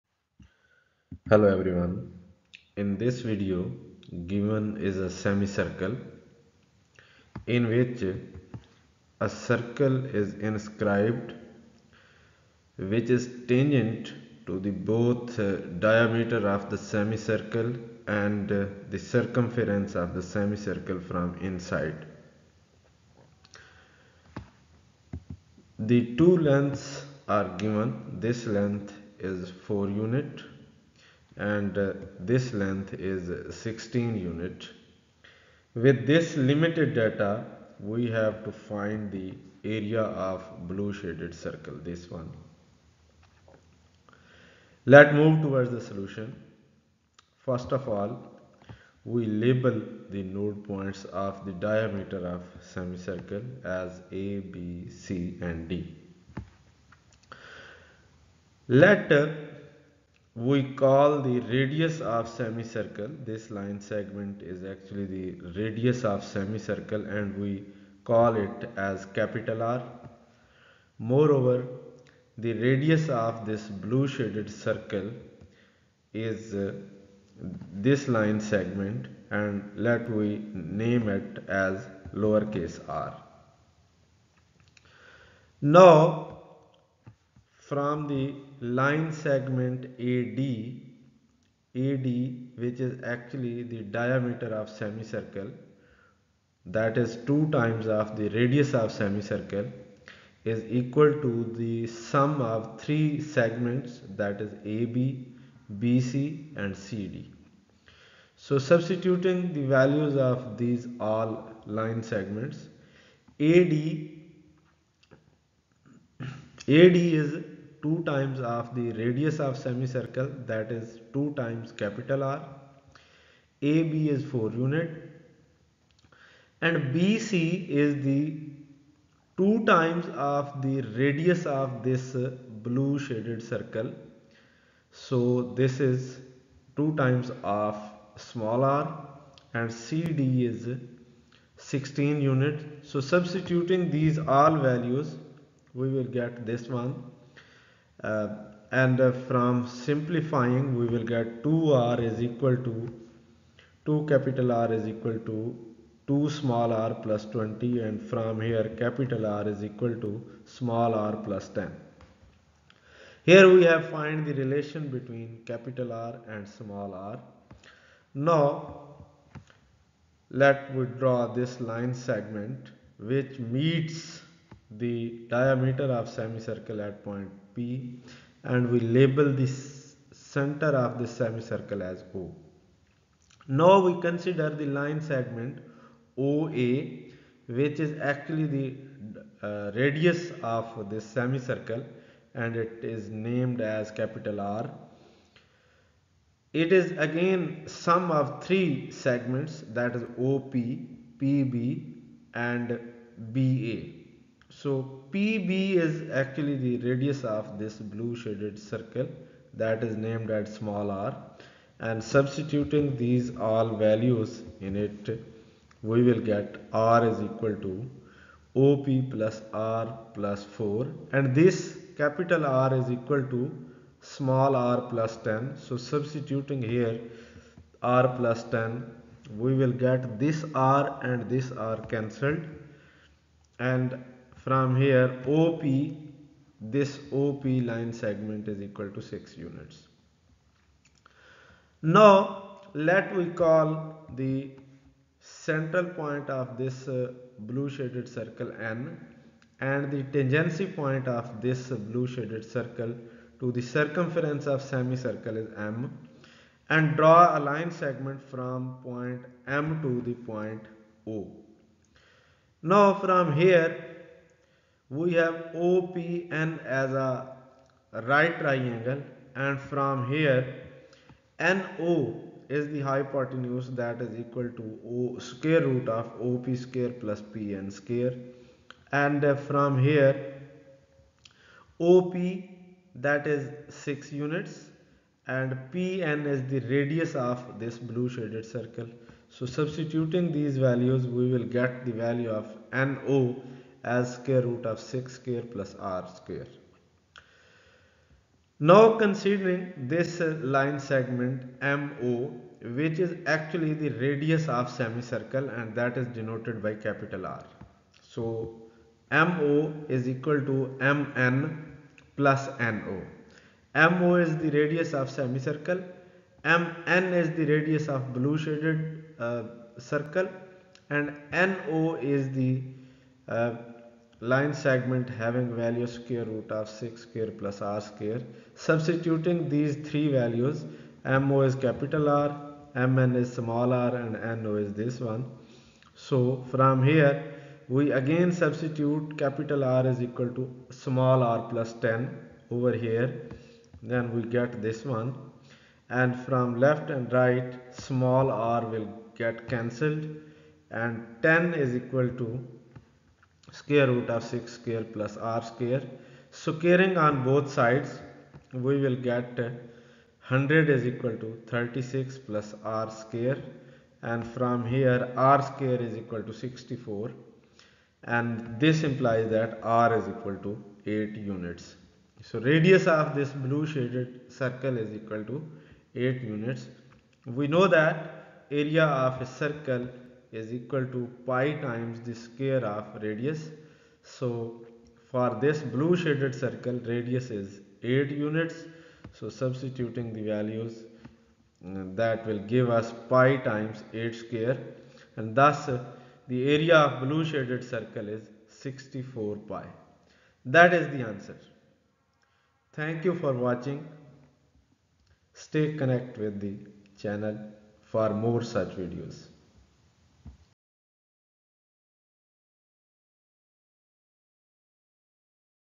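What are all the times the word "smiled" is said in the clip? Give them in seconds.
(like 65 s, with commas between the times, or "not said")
not said.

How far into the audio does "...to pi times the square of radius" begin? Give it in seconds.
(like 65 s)
380 s.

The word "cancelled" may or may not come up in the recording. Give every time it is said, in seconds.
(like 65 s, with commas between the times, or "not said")
231 s, 349 s.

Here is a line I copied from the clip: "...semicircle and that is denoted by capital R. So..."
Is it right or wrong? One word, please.
right.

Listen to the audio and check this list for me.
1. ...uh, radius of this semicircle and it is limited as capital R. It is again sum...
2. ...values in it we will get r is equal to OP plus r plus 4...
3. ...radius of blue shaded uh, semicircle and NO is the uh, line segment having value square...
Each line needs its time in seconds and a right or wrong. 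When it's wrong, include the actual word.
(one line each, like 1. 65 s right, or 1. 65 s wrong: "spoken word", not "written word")
1. 189 s wrong: "named", not "limited"
2. 213 s right
3. 317 s wrong: "circle", not "semicircle".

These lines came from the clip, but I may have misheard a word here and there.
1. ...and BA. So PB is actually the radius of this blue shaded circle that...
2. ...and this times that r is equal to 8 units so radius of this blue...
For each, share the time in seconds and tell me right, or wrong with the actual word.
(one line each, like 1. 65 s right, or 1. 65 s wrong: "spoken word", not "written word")
1. 202 s right
2. 368 s wrong: "implies", not "times".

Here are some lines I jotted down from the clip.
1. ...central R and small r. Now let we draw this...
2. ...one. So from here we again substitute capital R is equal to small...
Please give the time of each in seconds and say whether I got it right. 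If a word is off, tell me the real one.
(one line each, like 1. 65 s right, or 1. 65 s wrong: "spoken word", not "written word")
1. 165 s wrong: "capital", not "central"
2. 334 s right.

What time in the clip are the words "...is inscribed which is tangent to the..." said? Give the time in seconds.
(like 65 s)
10 s.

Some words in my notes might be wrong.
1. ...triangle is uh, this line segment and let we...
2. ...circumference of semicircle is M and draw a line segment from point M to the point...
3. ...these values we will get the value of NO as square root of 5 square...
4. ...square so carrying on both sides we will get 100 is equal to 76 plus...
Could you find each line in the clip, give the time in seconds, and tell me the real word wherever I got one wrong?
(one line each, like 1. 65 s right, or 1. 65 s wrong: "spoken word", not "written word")
1. 74 s wrong: "circle", not "triangle"
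2. 253 s right
3. 290 s wrong: "6", not "5"
4. 355 s wrong: "36", not "76".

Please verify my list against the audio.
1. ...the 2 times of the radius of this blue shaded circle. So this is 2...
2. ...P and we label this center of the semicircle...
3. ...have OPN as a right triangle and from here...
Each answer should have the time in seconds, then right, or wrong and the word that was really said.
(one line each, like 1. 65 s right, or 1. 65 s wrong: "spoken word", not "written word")
1. 128 s right
2. 177 s right
3. 265 s right.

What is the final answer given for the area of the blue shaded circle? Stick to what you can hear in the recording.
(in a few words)
64 pi.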